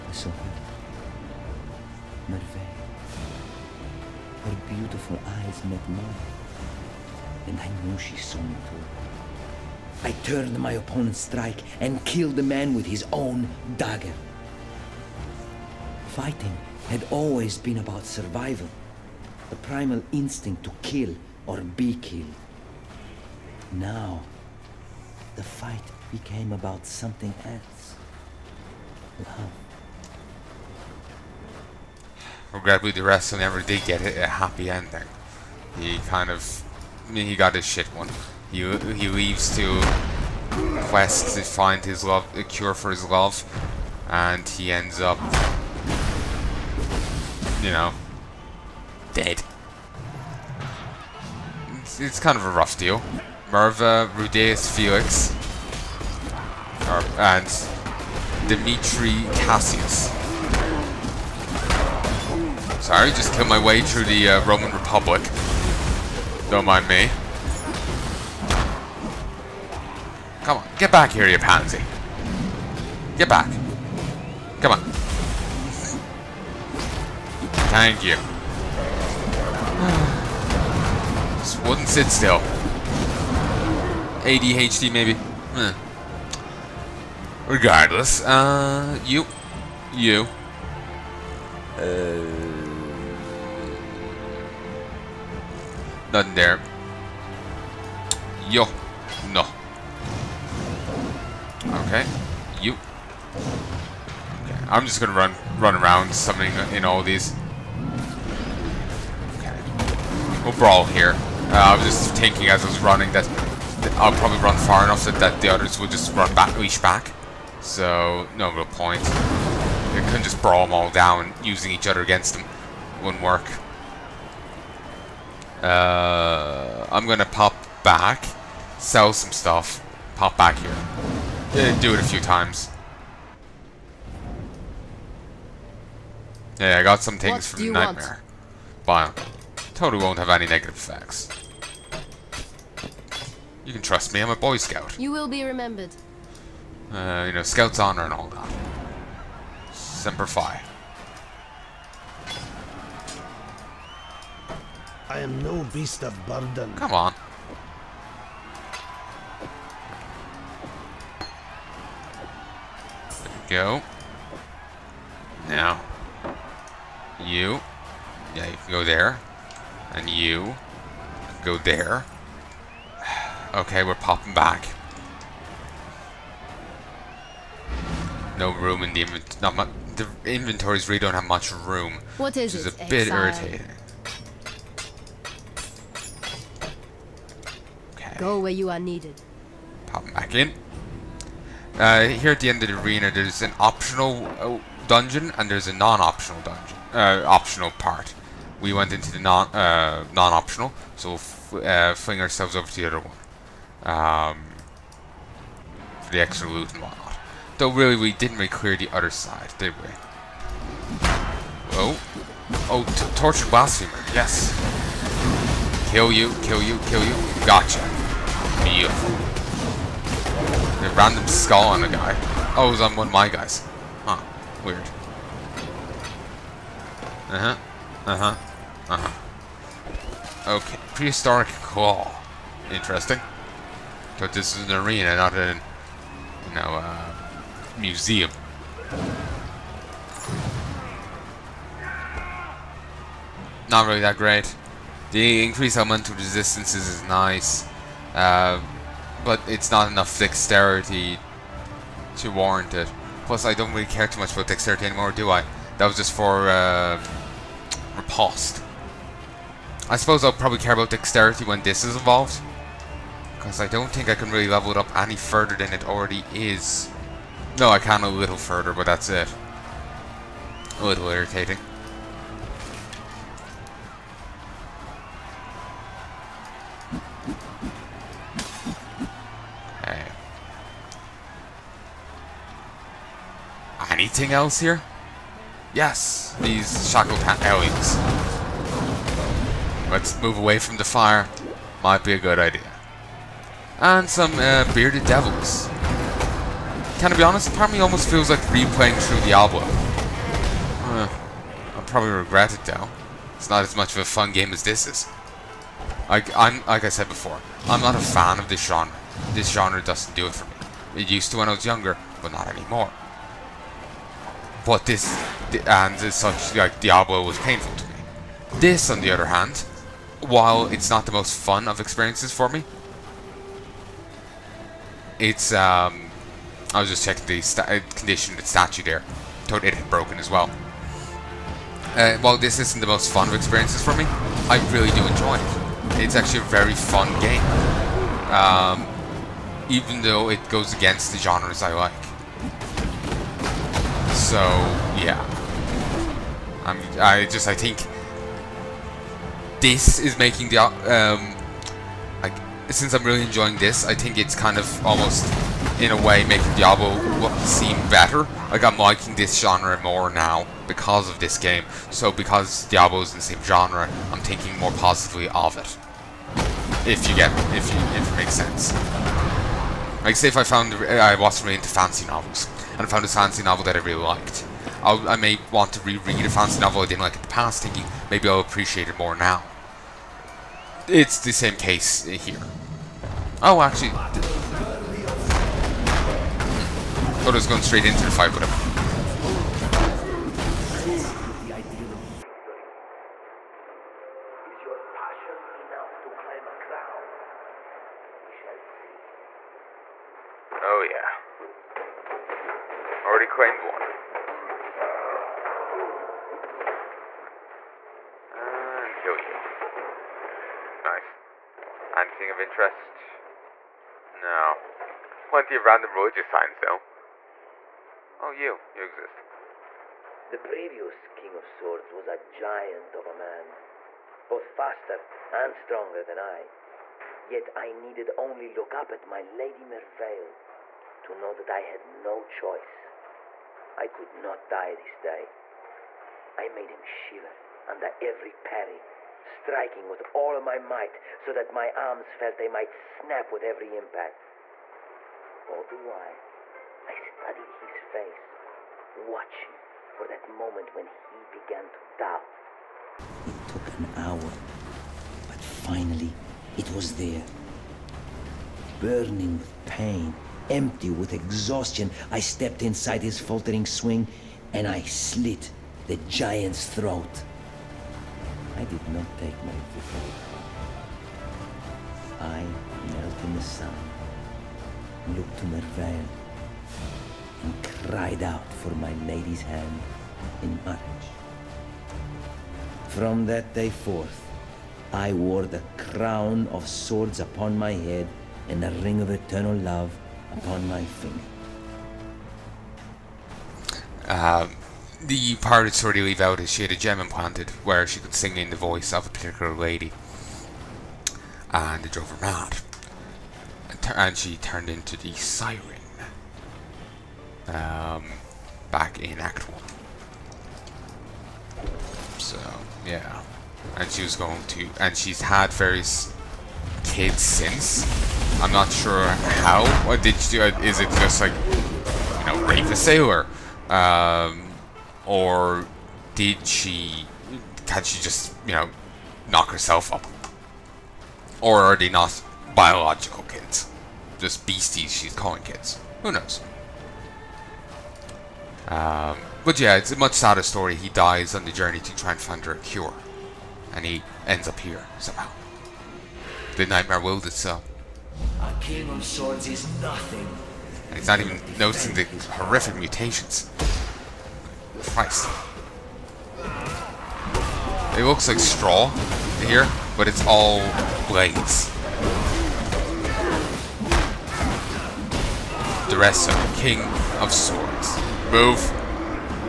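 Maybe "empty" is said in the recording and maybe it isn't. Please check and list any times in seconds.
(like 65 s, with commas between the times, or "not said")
460 s.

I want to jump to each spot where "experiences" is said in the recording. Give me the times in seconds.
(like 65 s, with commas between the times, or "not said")
321 s, 333 s.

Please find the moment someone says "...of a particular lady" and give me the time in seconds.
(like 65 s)
498 s.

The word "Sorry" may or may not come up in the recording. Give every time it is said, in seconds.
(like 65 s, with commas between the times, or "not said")
62 s.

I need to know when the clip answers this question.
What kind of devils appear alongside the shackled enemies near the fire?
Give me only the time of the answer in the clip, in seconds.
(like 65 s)
294 s.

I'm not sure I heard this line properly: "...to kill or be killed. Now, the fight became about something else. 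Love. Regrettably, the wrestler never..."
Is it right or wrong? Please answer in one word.
right.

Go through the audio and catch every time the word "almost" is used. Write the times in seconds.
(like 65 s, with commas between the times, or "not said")
297 s, 354 s.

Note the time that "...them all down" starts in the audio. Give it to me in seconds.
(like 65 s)
120 s.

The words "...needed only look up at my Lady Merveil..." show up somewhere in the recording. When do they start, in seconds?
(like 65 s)
427 s.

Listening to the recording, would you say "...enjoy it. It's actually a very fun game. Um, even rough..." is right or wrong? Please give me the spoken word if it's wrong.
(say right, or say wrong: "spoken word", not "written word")
wrong: "though", not "rough".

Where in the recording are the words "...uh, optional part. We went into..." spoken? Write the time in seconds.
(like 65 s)
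196 s.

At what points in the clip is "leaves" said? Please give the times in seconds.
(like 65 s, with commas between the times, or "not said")
39 s, 496 s.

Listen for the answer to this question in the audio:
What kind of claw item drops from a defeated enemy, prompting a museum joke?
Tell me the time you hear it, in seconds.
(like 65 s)
230 s.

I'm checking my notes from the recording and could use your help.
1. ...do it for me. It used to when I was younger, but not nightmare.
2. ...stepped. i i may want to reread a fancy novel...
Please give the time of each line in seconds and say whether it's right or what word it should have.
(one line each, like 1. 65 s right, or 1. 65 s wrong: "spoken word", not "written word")
1. 310 s wrong: "anymore", not "nightmare"
2. 374 s wrong: "liked", not "stepped".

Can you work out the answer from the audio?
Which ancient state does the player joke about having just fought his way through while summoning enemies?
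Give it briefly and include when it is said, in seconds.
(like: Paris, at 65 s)
Roman Republic, at 64 s.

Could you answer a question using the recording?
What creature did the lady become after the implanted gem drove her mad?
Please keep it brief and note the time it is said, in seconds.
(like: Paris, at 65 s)
the siren, at 504 s.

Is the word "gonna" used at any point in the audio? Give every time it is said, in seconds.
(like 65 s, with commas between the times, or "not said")
104 s, 127 s.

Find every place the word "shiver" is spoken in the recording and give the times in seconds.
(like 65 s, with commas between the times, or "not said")
436 s.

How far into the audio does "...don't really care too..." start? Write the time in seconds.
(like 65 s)
253 s.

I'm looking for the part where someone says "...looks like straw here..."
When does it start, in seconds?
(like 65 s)
558 s.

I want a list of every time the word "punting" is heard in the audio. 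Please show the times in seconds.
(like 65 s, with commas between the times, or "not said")
not said.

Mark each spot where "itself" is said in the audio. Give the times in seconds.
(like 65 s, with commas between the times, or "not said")
547 s.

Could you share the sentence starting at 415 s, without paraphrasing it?
Plenty of random religious signs, though.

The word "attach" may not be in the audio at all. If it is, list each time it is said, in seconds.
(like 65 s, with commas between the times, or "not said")
not said.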